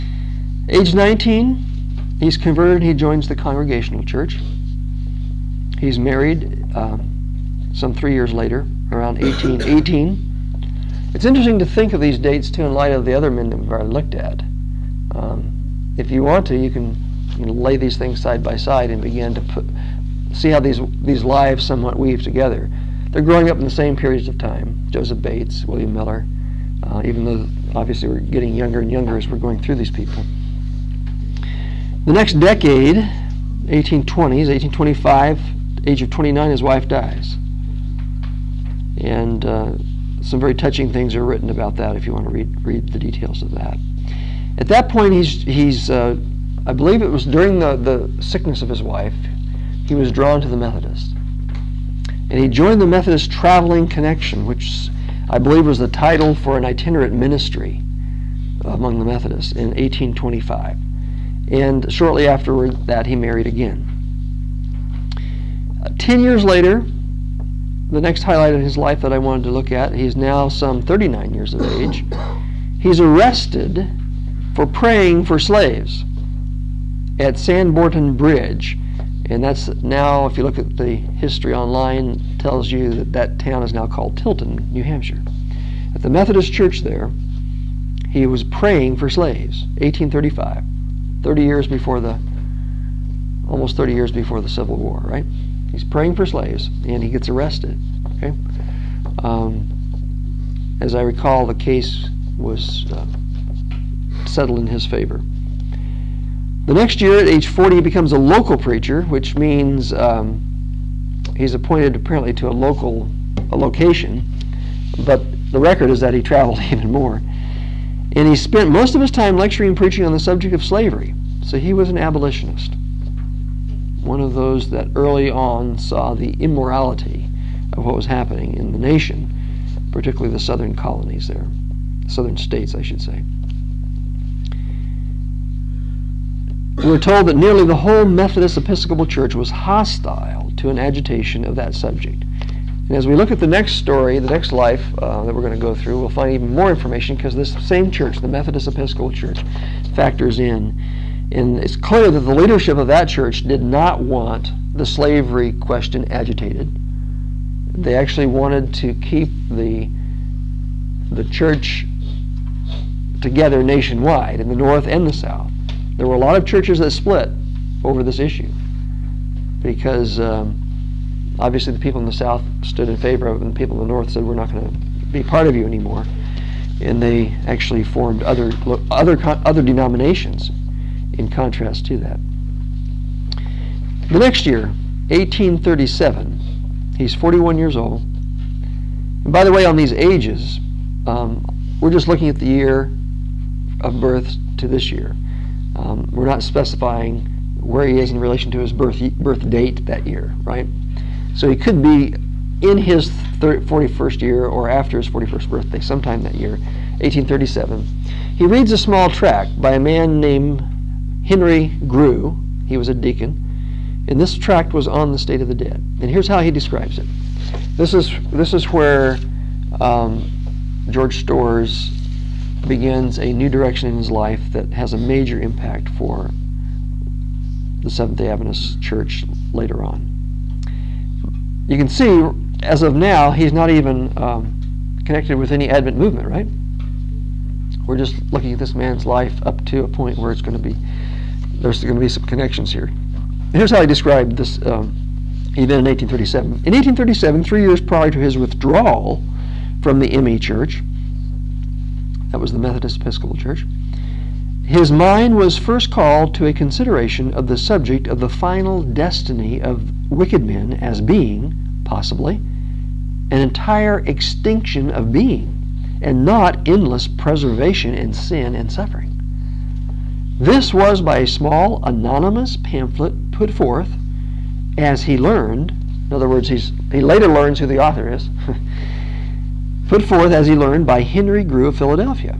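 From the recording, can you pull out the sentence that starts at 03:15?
Um, we're not specifying where he is in relation to his birth, birth date that year, right?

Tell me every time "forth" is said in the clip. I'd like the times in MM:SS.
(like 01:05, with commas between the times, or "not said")
04:33, 04:40.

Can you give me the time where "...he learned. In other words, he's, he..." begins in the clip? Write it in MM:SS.
04:35.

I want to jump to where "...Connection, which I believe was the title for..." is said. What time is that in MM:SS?
00:53.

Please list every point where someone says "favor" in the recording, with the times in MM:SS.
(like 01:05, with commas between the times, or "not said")
01:44, 02:52.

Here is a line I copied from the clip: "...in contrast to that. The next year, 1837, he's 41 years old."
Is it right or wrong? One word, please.
right.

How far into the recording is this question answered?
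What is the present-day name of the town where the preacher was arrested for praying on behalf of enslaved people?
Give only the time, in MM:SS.
01:24.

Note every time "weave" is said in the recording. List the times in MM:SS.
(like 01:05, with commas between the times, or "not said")
00:21.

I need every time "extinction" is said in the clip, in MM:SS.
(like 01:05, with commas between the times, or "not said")
04:24.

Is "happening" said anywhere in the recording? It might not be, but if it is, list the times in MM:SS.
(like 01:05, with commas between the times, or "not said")
02:08.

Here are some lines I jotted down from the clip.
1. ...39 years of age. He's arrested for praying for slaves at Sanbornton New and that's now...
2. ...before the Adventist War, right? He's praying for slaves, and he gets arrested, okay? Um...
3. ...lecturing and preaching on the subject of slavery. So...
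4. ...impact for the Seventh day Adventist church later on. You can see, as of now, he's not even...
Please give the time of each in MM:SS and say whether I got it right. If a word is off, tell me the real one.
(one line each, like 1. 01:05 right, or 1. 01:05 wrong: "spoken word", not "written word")
1. 01:10 wrong: "Bridge", not "New"
2. 01:34 wrong: "Civil", not "Adventist"
3. 01:59 right
4. 03:45 right.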